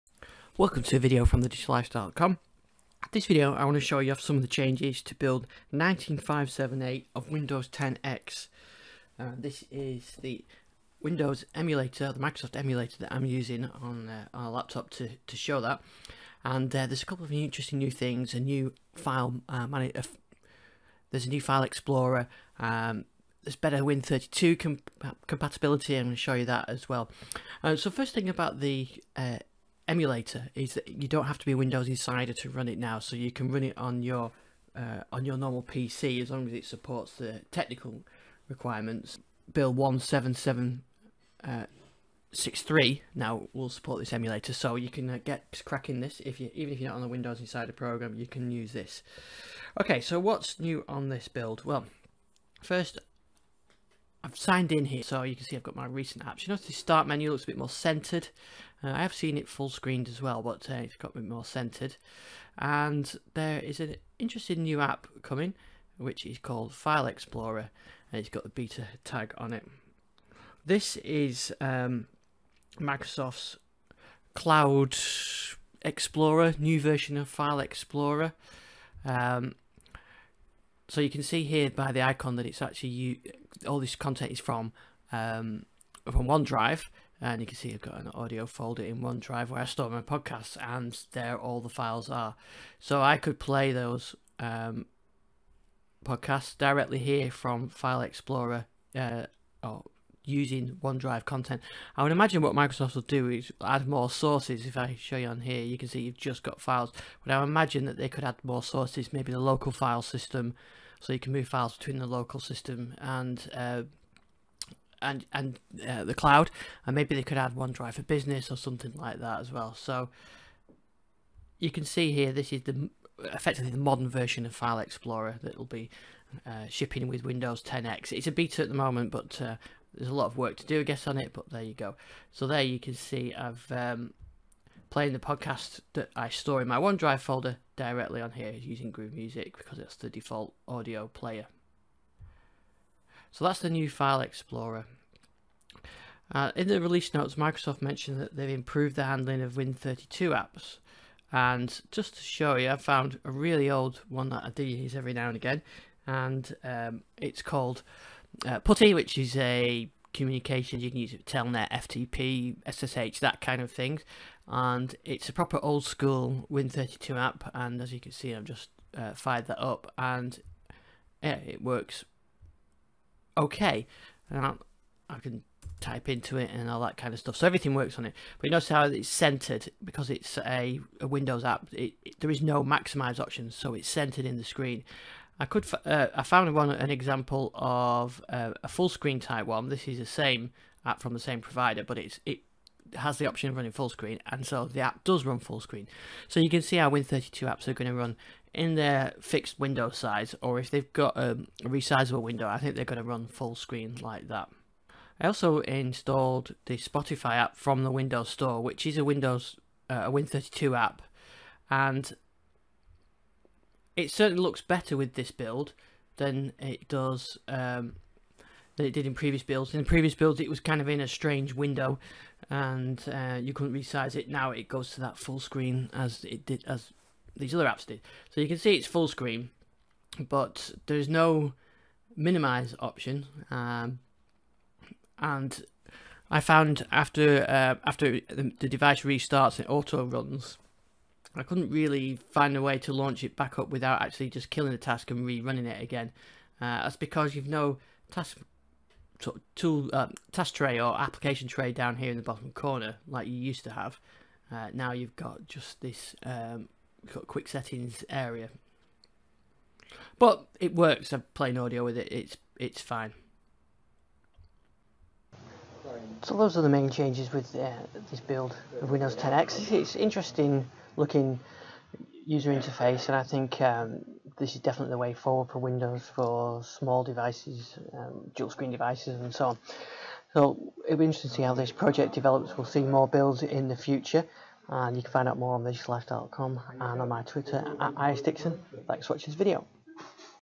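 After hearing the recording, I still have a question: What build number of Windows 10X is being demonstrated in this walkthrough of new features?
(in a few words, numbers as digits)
19578.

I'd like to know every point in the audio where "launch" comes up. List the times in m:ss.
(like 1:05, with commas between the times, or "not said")
4:02.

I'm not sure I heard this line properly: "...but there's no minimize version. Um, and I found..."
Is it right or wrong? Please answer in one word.
wrong.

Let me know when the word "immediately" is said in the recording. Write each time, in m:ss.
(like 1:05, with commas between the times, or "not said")
not said.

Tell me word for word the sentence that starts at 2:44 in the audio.
And it's a proper old school Win32 app.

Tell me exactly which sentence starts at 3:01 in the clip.
It, it, there is no maximize option, so it's centered in the screen.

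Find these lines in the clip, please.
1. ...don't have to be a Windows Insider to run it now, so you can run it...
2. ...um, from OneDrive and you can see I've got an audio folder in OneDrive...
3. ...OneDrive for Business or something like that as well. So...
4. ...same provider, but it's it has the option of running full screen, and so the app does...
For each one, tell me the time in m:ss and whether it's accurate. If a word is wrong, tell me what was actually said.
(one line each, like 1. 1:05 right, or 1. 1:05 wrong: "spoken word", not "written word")
1. 0:31 right
2. 1:25 right
3. 1:57 right
4. 3:11 right.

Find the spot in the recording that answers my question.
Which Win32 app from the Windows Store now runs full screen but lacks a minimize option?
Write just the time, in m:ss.
3:26.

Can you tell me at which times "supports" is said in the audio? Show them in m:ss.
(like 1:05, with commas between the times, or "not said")
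0:36, 0:43.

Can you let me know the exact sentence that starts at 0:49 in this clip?
Okay, so what's new on this build?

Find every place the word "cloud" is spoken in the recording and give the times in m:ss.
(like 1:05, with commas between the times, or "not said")
1:14, 1:56.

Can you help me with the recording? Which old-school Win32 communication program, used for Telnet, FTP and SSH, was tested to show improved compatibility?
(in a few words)
PuTTY.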